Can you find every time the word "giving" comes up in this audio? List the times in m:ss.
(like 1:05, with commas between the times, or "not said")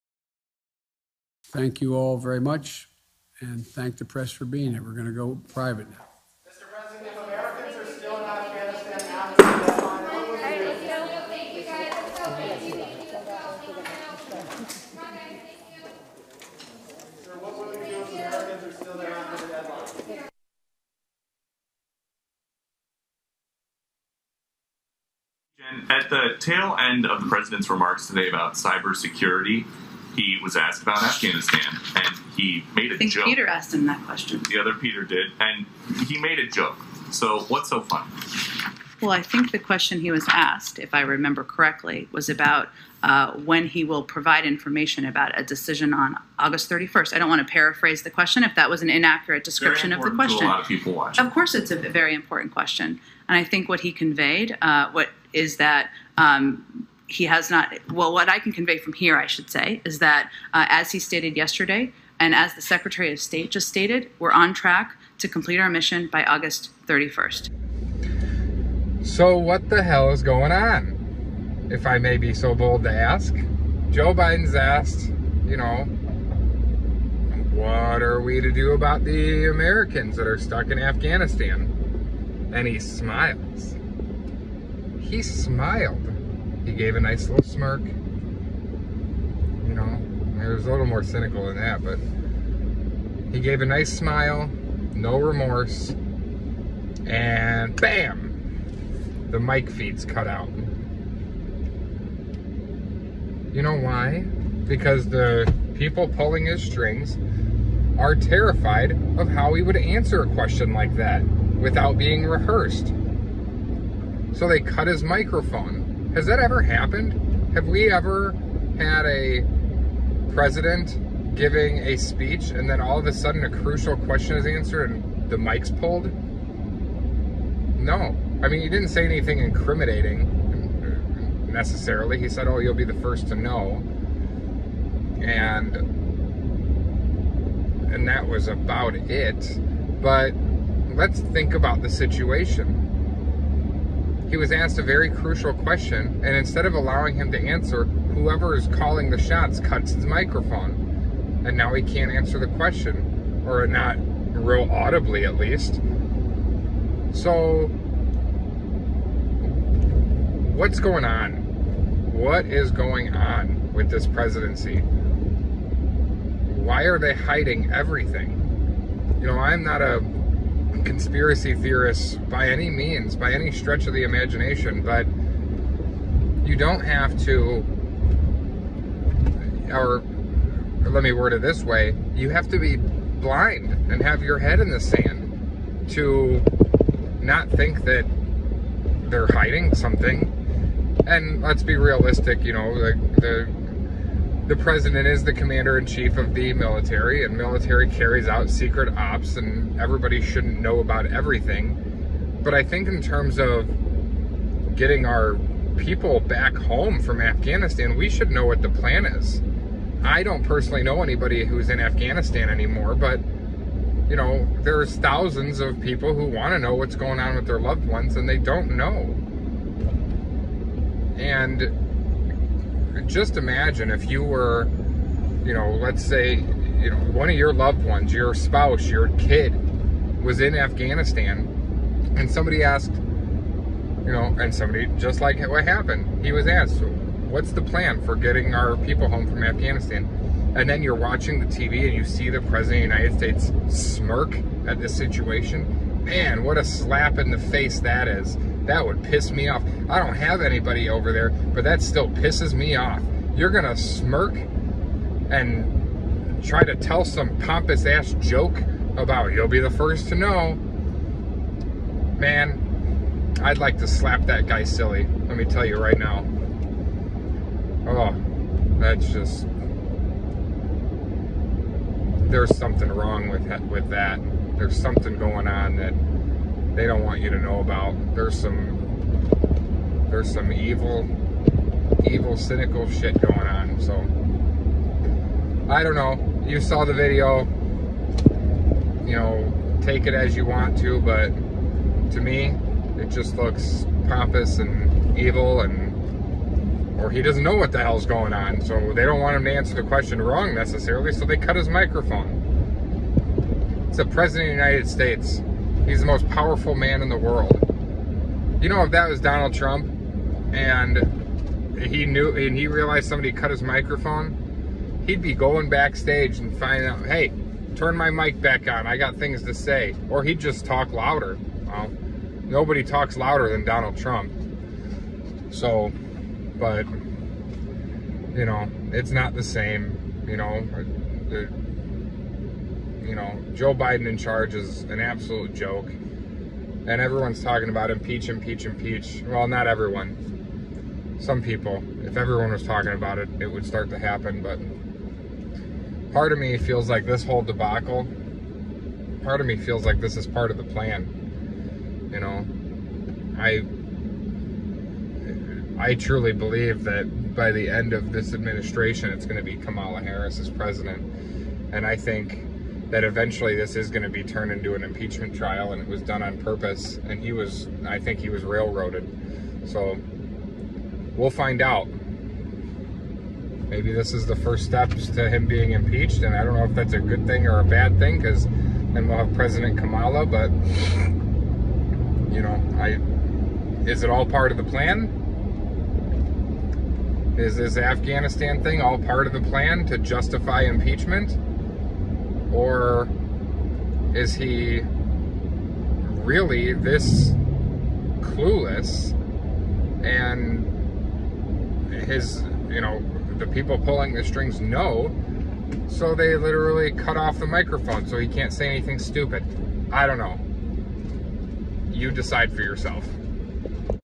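2:01.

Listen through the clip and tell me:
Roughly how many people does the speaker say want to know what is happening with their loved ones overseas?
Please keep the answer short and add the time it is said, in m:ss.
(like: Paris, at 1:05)
Thousands, at 3:34.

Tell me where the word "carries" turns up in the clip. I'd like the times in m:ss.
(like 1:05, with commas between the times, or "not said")
3:17.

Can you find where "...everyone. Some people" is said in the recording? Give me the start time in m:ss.
5:39.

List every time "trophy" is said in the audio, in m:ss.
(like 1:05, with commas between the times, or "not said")
not said.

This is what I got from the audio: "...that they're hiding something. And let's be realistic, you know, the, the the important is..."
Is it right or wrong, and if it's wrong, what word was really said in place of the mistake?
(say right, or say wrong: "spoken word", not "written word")
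wrong: "president", not "important".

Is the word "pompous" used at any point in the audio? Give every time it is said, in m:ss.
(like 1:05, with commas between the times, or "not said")
4:17, 4:54.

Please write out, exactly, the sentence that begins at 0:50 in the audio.
Of, of course, it's a very important question.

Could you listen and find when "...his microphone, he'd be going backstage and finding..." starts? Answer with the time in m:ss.
5:13.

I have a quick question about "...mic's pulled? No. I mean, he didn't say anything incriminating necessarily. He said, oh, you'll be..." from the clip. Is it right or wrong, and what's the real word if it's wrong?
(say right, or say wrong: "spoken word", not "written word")
right.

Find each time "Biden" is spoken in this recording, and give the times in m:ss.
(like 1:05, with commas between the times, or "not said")
1:14, 5:33.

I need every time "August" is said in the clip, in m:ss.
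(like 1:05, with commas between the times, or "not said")
0:46, 1:06.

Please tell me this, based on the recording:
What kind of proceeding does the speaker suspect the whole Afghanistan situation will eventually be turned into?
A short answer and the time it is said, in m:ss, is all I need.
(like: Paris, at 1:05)
Impeachment trial, at 6:04.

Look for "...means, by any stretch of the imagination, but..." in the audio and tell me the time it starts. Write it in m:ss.
2:52.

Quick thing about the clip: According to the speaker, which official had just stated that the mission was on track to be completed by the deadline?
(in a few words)
Secretary of State.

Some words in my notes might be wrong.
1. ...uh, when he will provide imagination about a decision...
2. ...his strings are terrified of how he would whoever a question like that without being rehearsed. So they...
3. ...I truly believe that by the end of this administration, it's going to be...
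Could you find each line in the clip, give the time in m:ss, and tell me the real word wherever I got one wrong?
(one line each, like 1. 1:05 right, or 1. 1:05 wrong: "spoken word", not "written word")
1. 0:43 wrong: "information", not "imagination"
2. 1:46 wrong: "answer", not "whoever"
3. 5:55 right.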